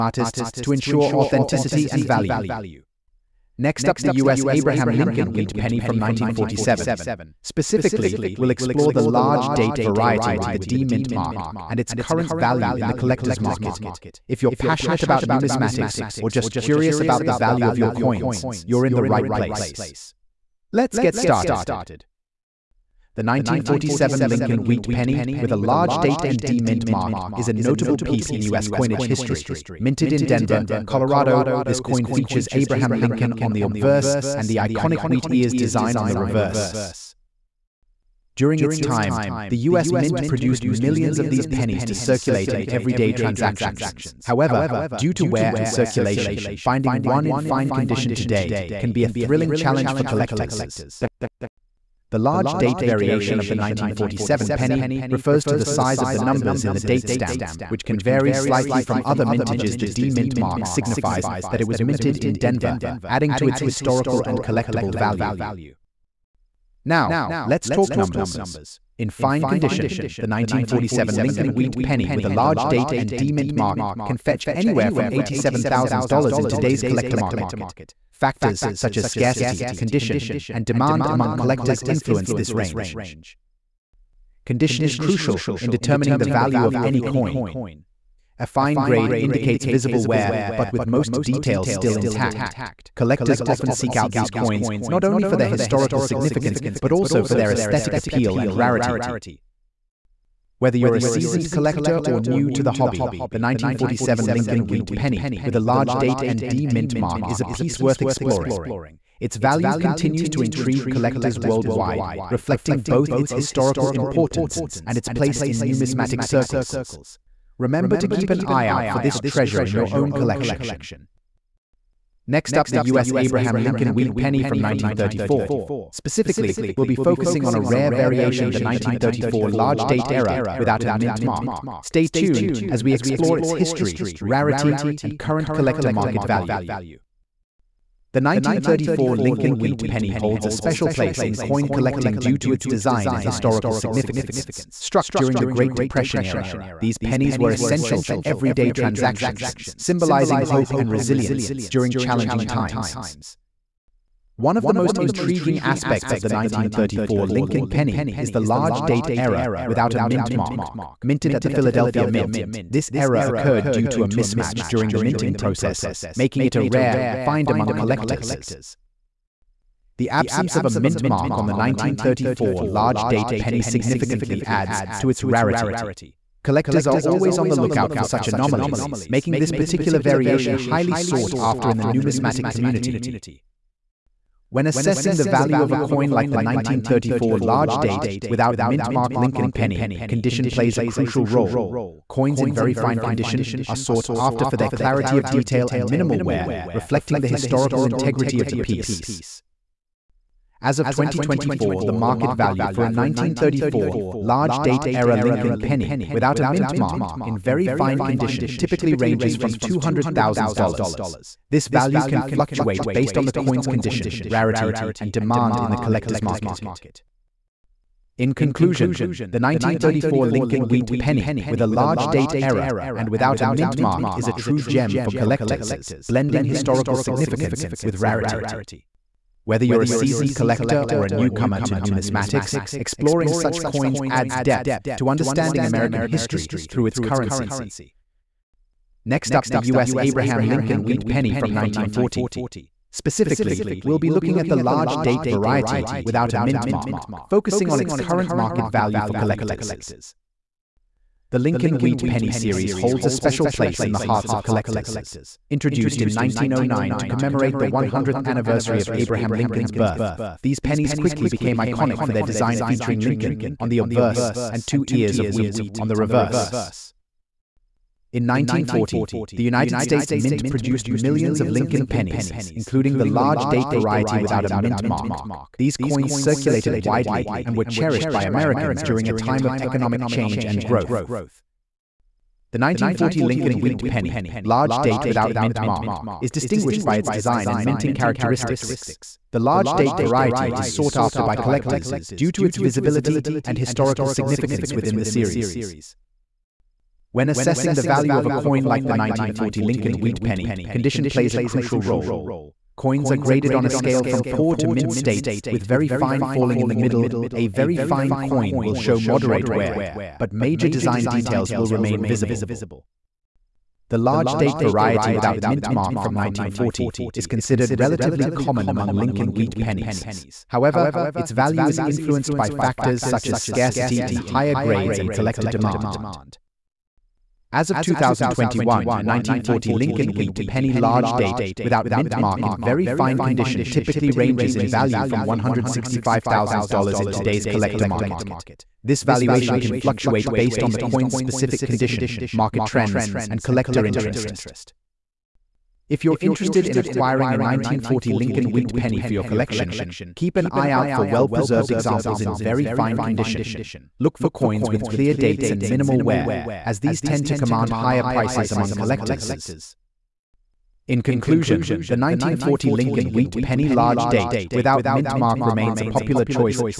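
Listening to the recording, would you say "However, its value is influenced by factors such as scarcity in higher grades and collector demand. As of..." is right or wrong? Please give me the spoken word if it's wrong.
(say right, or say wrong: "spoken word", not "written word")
right.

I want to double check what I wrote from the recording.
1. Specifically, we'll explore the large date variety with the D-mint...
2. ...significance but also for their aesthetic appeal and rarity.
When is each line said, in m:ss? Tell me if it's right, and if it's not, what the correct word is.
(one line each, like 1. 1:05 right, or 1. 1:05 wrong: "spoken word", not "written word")
1. 0:07 right
2. 1:36 right.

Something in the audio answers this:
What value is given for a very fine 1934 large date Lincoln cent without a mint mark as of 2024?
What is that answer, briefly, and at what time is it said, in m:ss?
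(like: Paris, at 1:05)
$200,000, at 3:29.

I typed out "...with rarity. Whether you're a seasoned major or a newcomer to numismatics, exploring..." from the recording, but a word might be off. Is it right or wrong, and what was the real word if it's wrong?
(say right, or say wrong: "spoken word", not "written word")
wrong: "collector", not "major".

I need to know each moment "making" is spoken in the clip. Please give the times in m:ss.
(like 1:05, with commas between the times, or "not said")
2:46, 2:59.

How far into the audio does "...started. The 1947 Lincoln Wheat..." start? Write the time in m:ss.
0:21.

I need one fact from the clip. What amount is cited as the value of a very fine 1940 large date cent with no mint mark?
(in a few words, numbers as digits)
$165,000.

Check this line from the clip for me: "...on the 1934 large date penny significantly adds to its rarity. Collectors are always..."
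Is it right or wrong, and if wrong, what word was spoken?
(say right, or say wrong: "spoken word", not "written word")
right.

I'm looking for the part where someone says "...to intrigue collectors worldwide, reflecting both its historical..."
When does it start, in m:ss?
1:50.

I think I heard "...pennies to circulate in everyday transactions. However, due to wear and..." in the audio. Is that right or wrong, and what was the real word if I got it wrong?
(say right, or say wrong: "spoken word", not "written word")
right.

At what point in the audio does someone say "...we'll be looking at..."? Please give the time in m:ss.
4:03.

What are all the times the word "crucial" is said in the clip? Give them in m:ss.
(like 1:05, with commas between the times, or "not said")
1:24, 3:10, 5:01.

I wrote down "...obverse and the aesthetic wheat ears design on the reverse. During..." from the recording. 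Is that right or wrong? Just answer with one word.
wrong.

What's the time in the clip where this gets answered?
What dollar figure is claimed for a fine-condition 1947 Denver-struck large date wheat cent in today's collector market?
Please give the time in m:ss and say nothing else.
1:15.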